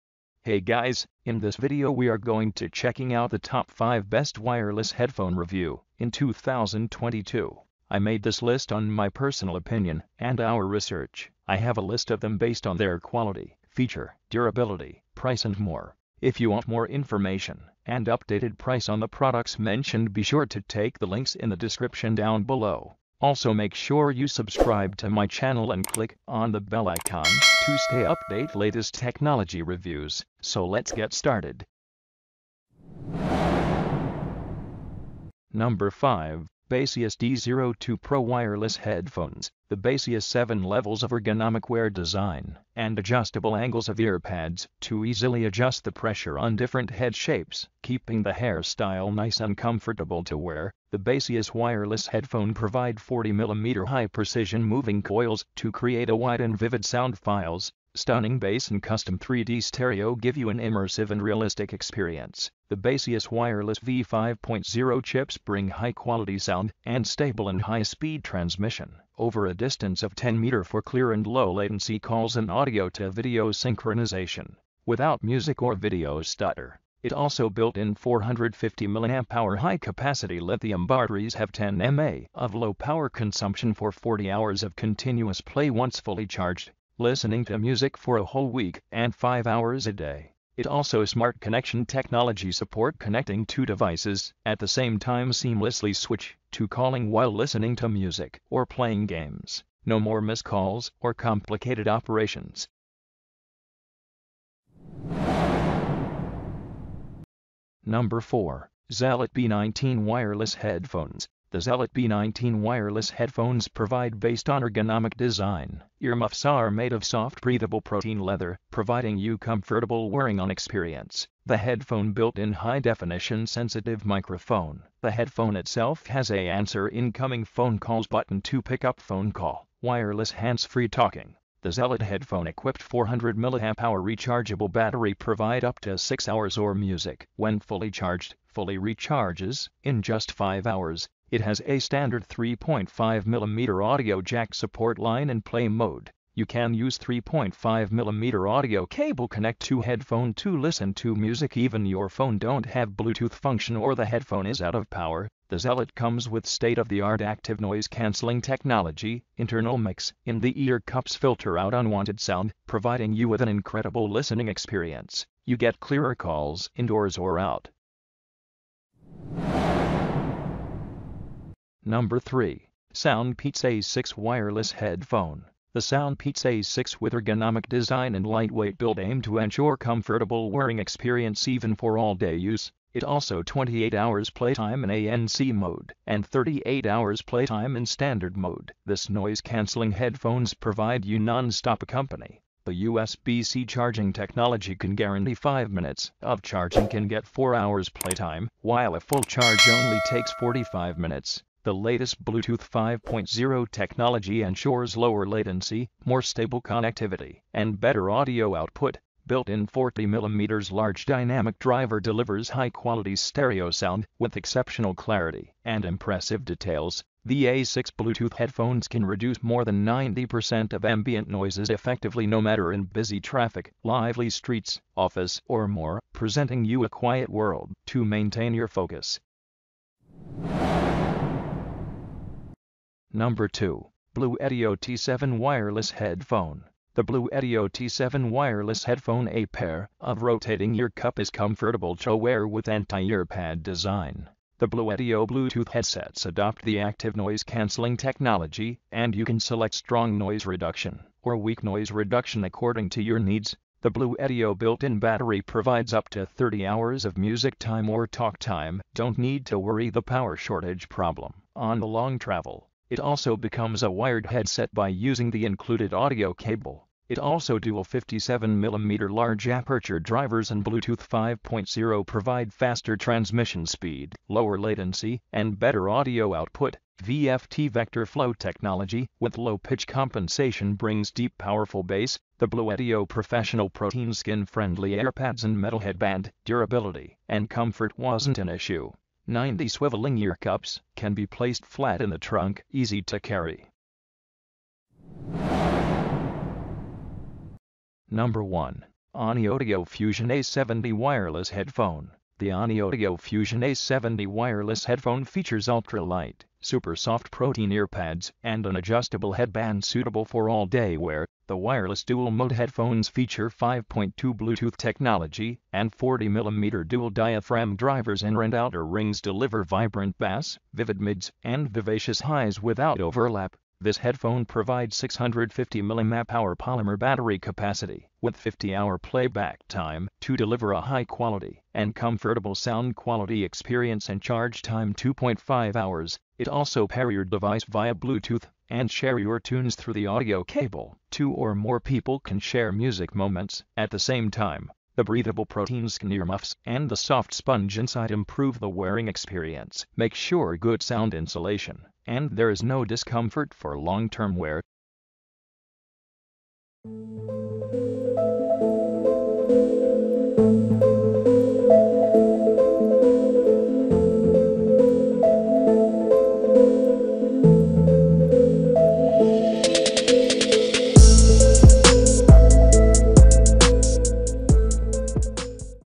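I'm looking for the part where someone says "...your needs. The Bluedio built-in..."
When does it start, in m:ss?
4:13.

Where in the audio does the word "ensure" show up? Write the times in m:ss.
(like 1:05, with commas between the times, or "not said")
2:59, 3:24.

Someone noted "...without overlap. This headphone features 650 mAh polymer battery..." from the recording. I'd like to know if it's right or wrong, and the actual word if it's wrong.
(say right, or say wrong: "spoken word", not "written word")
wrong: "provides", not "features".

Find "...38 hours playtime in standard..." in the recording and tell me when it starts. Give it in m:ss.
3:06.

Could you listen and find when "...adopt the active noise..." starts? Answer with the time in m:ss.
4:06.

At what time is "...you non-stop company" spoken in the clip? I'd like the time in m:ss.
3:11.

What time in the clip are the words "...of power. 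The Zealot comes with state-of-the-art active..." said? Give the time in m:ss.
2:34.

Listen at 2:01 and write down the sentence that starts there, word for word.
The headphone built in high definition sensitive microphone.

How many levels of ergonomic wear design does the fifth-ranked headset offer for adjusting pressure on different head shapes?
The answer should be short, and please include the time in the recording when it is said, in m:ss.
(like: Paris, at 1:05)
7, at 0:40.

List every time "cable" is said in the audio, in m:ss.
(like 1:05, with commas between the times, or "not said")
2:28, 4:26, 5:40.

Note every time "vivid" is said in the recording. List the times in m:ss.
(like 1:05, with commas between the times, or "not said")
0:56, 5:20.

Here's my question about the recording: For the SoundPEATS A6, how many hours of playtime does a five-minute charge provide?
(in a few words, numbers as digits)
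4 hours.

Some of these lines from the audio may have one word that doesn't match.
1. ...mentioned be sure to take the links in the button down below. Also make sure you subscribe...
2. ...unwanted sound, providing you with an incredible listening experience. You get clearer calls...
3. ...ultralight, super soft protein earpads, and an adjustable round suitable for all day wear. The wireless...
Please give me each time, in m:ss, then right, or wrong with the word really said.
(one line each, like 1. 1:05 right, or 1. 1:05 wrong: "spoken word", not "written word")
1. 0:19 wrong: "description", not "button"
2. 2:41 right
3. 5:05 wrong: "headband", not "round".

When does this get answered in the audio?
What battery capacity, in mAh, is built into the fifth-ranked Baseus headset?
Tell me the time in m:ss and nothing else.
1:17.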